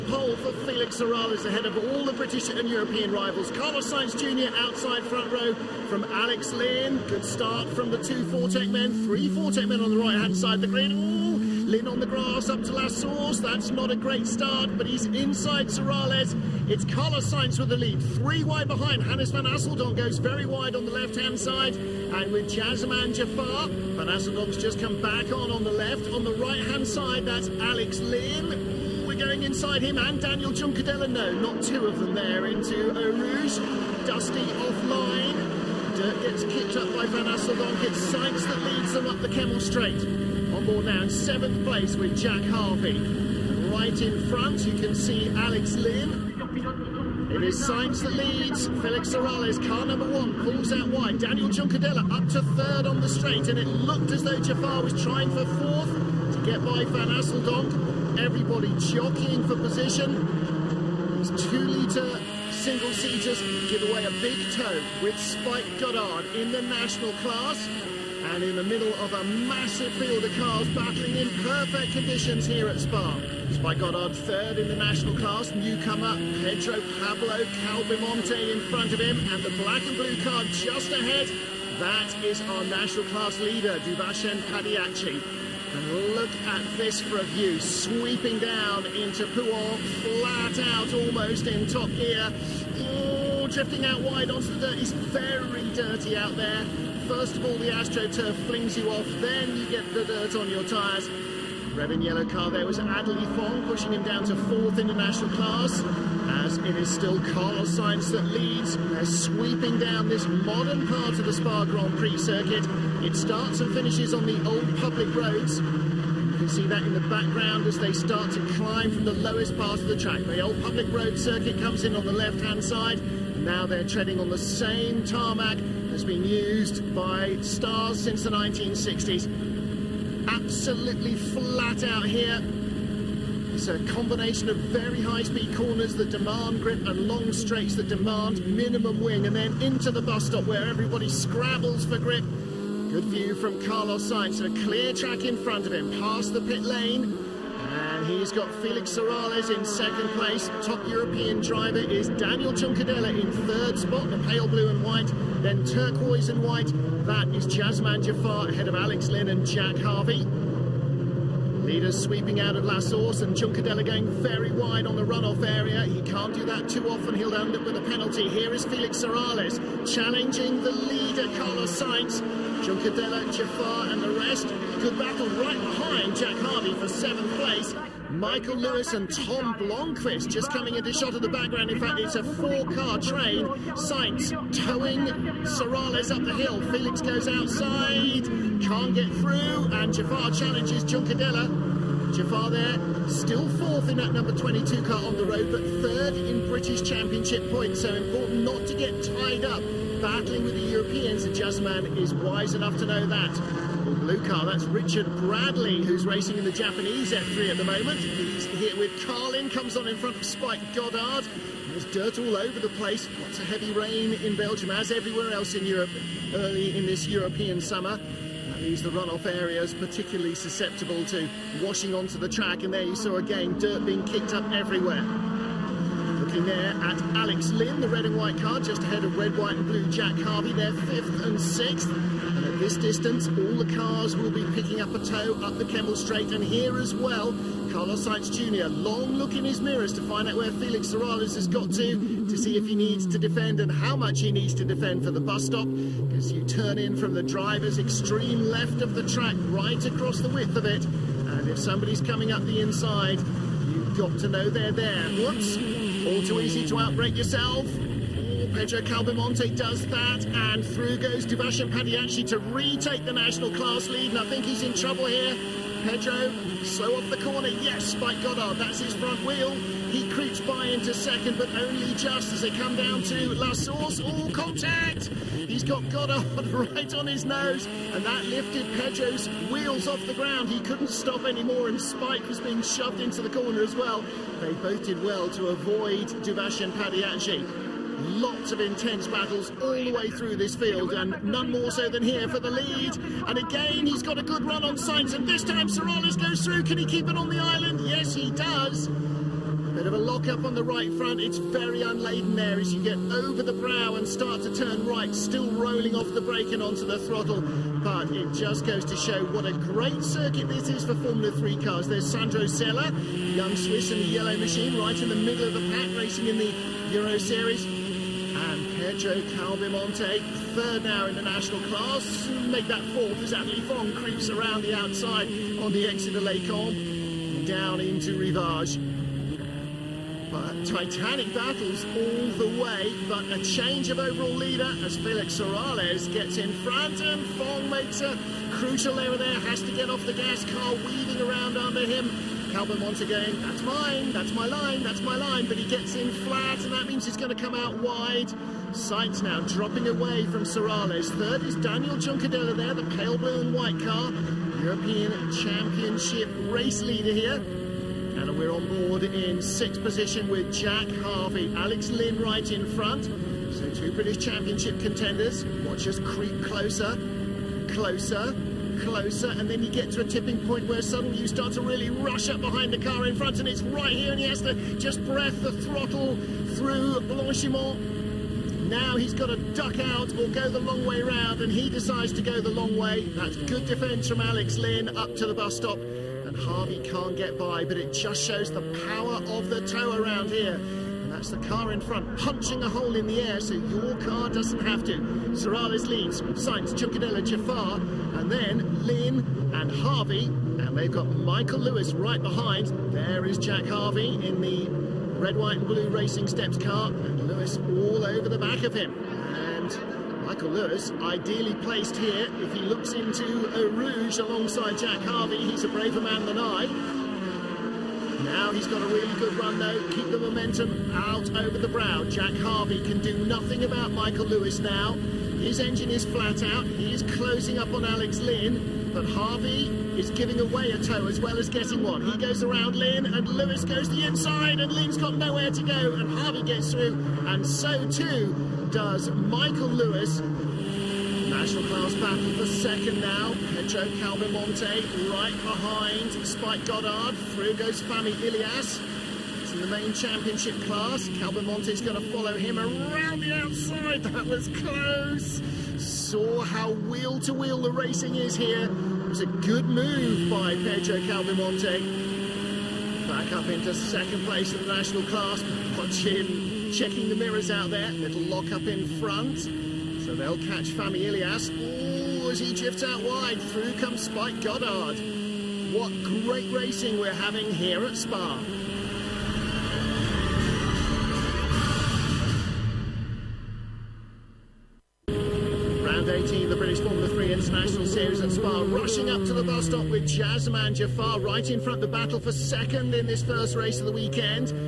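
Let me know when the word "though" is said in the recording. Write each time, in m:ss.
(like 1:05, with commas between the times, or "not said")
0:54, 6:59.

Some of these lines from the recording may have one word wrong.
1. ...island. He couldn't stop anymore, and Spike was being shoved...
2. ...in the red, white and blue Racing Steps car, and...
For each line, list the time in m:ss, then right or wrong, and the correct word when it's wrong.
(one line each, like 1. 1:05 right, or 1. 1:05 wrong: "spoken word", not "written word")
1. 4:40 wrong: "ground", not "island"
2. 6:44 right.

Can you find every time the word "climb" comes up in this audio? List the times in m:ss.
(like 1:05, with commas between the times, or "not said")
1:58.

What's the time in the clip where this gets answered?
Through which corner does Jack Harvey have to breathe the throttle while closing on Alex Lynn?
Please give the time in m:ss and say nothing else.
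6:16.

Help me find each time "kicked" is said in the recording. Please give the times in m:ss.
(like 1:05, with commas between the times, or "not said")
0:36, 3:44.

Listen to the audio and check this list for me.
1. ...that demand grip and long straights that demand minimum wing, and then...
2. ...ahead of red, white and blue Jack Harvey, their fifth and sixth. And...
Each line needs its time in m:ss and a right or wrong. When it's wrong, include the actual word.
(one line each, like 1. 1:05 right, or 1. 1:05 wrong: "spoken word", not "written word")
1. 2:15 right
2. 3:48 right.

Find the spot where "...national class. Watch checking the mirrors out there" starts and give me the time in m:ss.
7:44.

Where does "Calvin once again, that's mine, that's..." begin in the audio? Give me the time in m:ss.
5:42.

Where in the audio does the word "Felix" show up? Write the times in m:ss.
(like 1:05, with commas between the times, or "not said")
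0:00, 0:48, 2:28, 2:48, 3:06, 4:00, 5:34.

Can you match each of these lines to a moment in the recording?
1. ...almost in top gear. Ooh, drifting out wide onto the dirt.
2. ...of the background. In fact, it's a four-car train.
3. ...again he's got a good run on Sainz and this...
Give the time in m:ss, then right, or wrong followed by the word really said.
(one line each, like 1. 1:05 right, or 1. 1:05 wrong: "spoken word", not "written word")
1. 1:30 right
2. 3:01 right
3. 4:53 right.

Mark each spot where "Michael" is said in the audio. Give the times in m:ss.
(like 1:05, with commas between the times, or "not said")
2:58, 6:41, 6:50, 7:03, 7:19.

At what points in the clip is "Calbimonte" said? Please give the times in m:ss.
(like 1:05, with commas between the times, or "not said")
1:17, 4:18, 5:19, 7:24, 7:41.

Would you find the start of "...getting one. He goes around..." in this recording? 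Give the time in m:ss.
7:11.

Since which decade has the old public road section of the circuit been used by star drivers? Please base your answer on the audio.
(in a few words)
1960s.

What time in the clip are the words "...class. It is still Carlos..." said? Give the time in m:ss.
1:45.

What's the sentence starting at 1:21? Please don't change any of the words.
That is our national class leader, Duvashen Padayachee.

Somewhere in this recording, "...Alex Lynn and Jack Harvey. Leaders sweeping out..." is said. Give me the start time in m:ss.
2:38.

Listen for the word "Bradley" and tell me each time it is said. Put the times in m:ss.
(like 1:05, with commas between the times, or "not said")
3:25.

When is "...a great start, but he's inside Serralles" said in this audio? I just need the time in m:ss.
0:13.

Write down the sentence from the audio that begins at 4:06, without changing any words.
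As you turn in from the driver's extreme left of the track, right across the width of it.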